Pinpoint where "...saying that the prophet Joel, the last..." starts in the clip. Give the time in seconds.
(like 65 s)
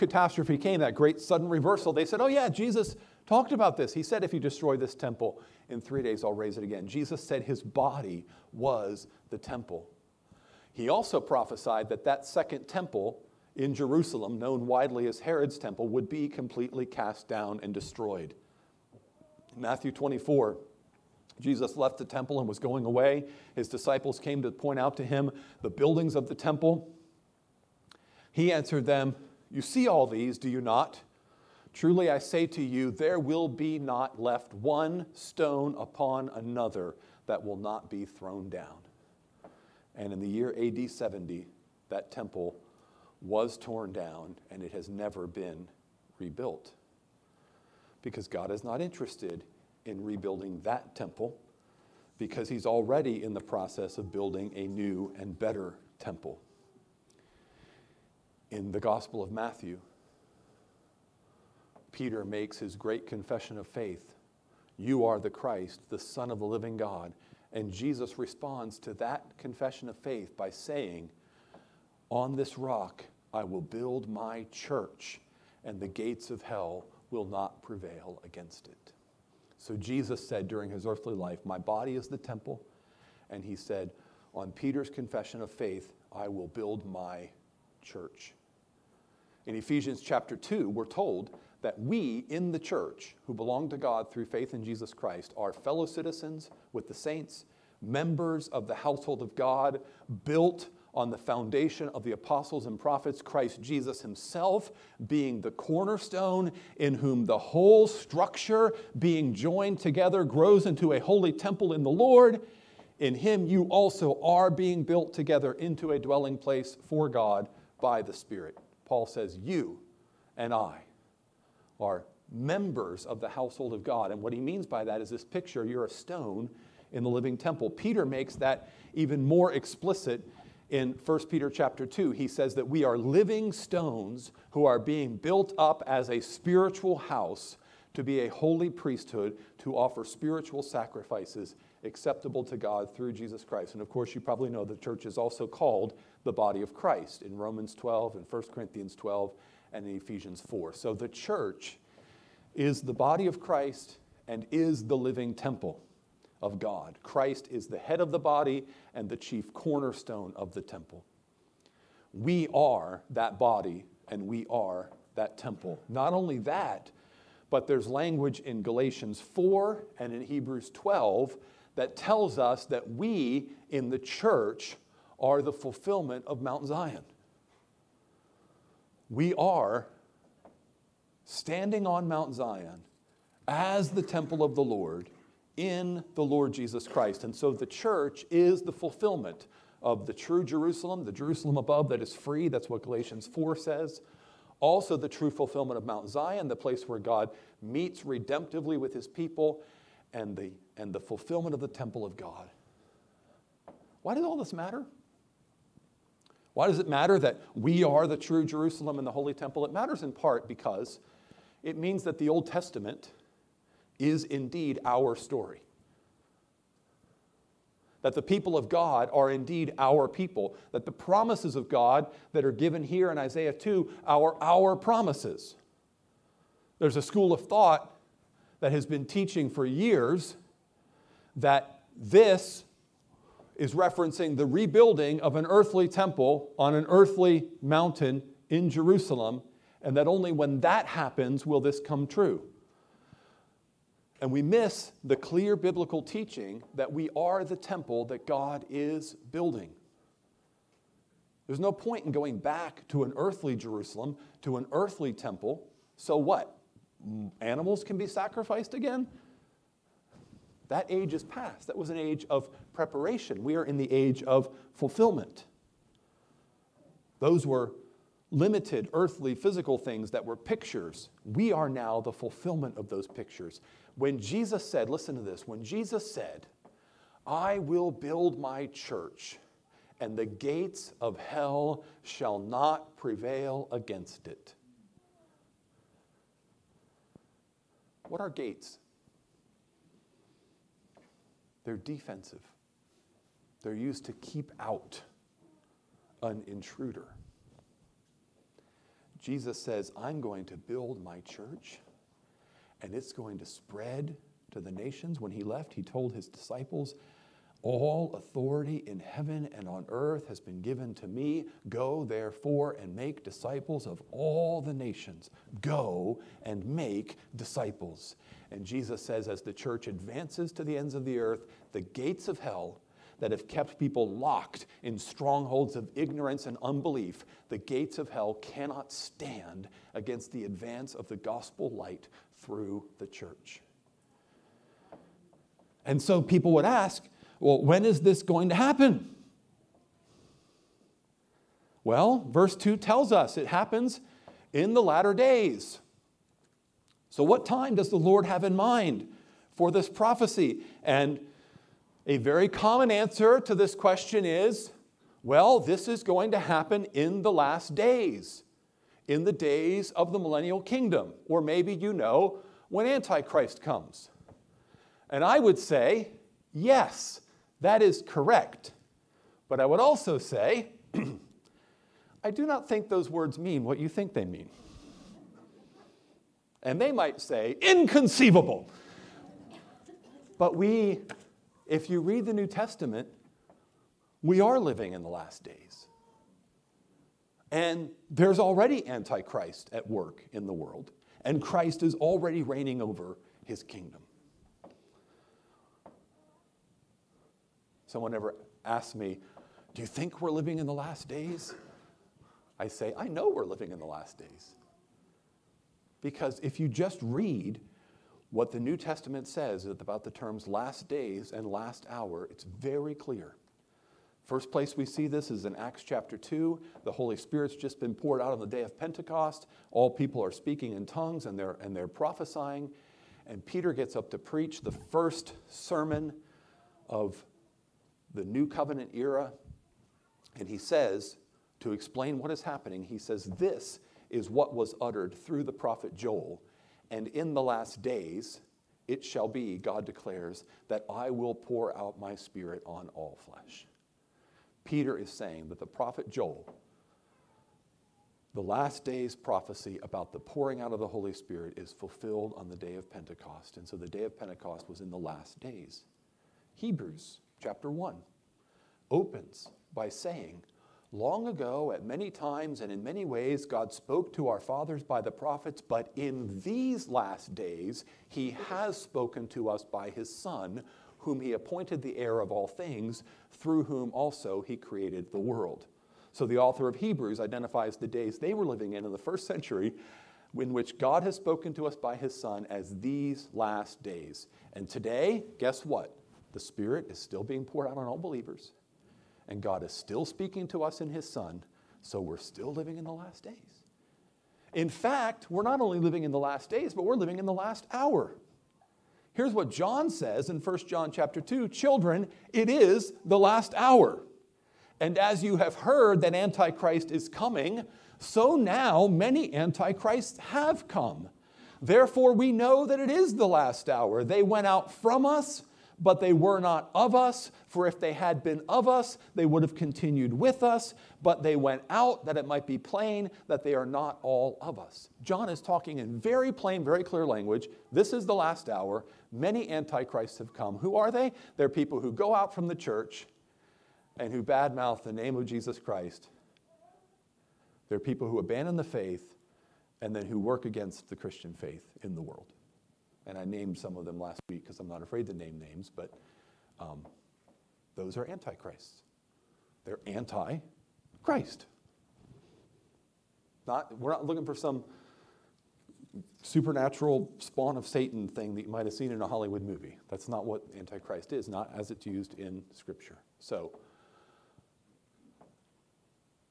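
445 s.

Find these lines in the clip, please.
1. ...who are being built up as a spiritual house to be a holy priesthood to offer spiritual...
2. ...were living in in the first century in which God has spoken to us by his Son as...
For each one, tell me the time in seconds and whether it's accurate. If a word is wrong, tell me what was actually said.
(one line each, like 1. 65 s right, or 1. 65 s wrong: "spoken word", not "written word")
1. 134 s right
2. 478 s right.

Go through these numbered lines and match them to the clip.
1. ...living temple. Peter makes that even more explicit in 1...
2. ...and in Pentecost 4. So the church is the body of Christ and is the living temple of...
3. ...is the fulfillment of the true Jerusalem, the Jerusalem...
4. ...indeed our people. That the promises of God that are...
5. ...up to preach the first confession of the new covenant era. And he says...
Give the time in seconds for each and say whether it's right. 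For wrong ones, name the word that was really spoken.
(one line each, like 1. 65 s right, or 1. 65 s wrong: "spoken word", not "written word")
1. 127 s right
2. 149 s wrong: "Ephesians", not "Pentecost"
3. 188 s right
4. 219 s right
5. 423 s wrong: "sermon", not "confession".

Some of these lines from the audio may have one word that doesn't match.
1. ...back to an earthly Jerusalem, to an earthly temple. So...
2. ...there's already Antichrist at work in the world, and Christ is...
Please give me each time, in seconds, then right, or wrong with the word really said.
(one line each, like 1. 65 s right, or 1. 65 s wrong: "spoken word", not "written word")
1. 252 s right
2. 388 s right.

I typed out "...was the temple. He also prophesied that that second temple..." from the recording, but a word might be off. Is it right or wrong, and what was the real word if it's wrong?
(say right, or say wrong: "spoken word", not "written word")
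right.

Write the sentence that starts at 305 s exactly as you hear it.
When he left, he told his disciples, All authority in heaven and on earth has been given to me.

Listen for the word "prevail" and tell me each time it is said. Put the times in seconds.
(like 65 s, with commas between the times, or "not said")
77 s, 282 s.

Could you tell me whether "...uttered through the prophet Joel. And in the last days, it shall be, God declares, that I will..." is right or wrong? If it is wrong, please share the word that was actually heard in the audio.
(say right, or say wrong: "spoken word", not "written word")
right.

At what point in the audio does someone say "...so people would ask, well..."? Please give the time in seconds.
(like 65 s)
336 s.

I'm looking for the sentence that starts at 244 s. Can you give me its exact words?
And we miss the clear biblical teaching that we are the temple that God is building.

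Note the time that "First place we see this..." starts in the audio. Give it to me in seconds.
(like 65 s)
414 s.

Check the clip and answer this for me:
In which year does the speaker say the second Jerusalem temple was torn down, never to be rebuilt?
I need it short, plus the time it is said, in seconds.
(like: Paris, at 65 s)
AD 70, at 40 s.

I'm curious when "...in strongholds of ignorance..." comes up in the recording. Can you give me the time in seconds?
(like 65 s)
324 s.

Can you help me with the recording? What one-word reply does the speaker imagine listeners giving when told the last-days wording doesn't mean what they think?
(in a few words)
inconceivable.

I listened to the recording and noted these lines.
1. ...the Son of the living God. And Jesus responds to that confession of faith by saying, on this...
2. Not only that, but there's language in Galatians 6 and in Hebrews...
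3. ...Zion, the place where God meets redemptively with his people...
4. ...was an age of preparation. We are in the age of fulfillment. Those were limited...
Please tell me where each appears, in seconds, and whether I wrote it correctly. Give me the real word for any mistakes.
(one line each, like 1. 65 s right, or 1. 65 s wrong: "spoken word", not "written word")
1. 65 s right
2. 165 s wrong: "4", not "6"
3. 196 s right
4. 261 s right.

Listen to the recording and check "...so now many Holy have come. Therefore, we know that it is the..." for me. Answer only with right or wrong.
wrong.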